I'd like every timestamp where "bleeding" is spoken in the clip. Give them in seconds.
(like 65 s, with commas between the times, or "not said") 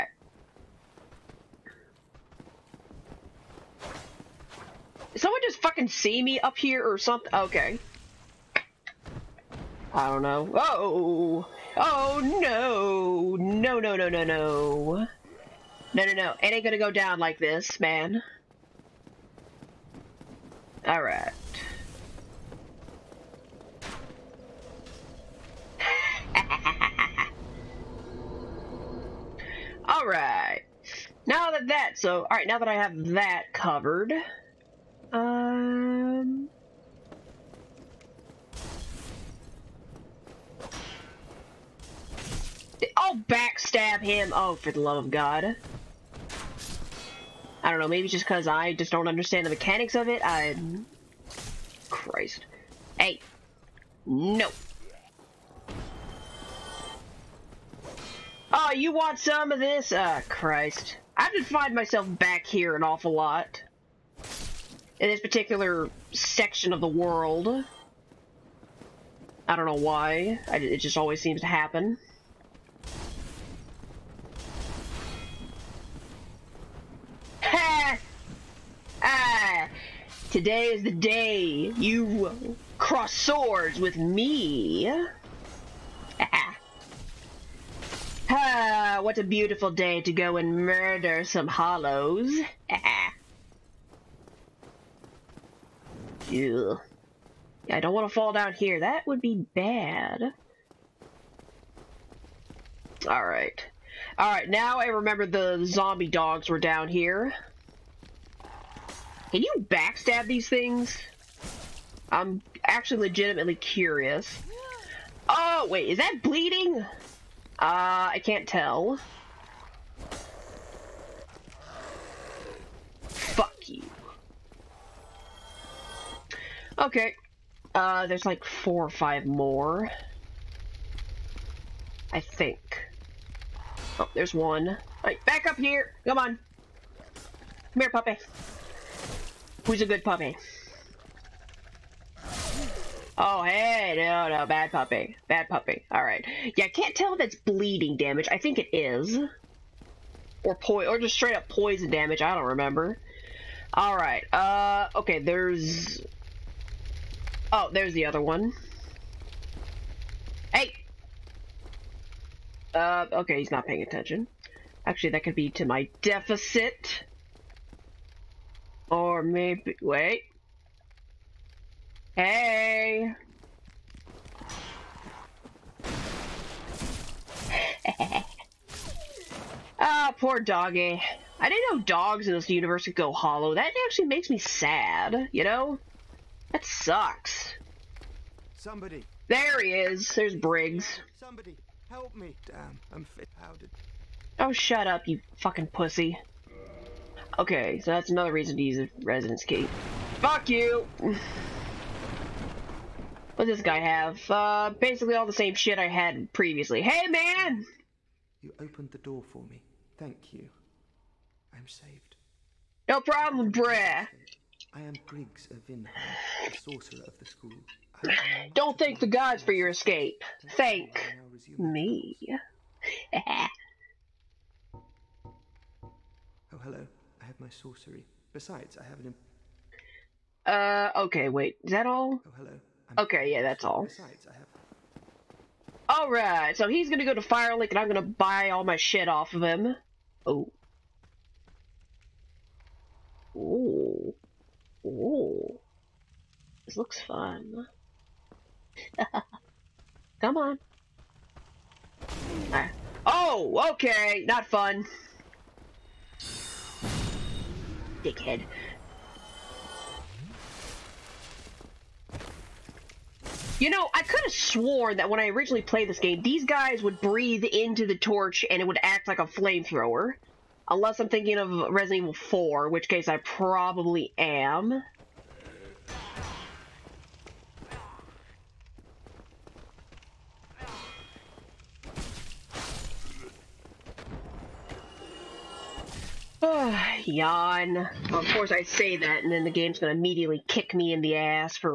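116 s, 147 s.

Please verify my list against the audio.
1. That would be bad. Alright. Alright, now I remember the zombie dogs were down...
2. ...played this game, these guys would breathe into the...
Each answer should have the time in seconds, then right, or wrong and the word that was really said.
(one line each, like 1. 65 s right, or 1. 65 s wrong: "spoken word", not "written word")
1. 98 s right
2. 265 s right.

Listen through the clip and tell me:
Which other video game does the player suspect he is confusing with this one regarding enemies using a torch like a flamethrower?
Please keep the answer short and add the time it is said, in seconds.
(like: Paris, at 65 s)
Resident Evil 4, at 271 s.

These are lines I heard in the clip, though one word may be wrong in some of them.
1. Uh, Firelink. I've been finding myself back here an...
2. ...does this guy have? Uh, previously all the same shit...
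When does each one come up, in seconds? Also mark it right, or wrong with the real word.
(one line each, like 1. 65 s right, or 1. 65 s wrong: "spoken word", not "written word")
1. 59 s wrong: "Christ", not "Firelink"
2. 203 s wrong: "basically", not "previously".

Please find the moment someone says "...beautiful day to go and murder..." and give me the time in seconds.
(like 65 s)
89 s.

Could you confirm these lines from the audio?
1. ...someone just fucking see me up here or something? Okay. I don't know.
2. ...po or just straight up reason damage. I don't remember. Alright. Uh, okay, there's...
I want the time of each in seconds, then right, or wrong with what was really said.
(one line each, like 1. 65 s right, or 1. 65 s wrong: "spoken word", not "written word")
1. 5 s right
2. 150 s wrong: "poison", not "reason".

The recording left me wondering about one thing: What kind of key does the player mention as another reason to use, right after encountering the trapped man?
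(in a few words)
residence key.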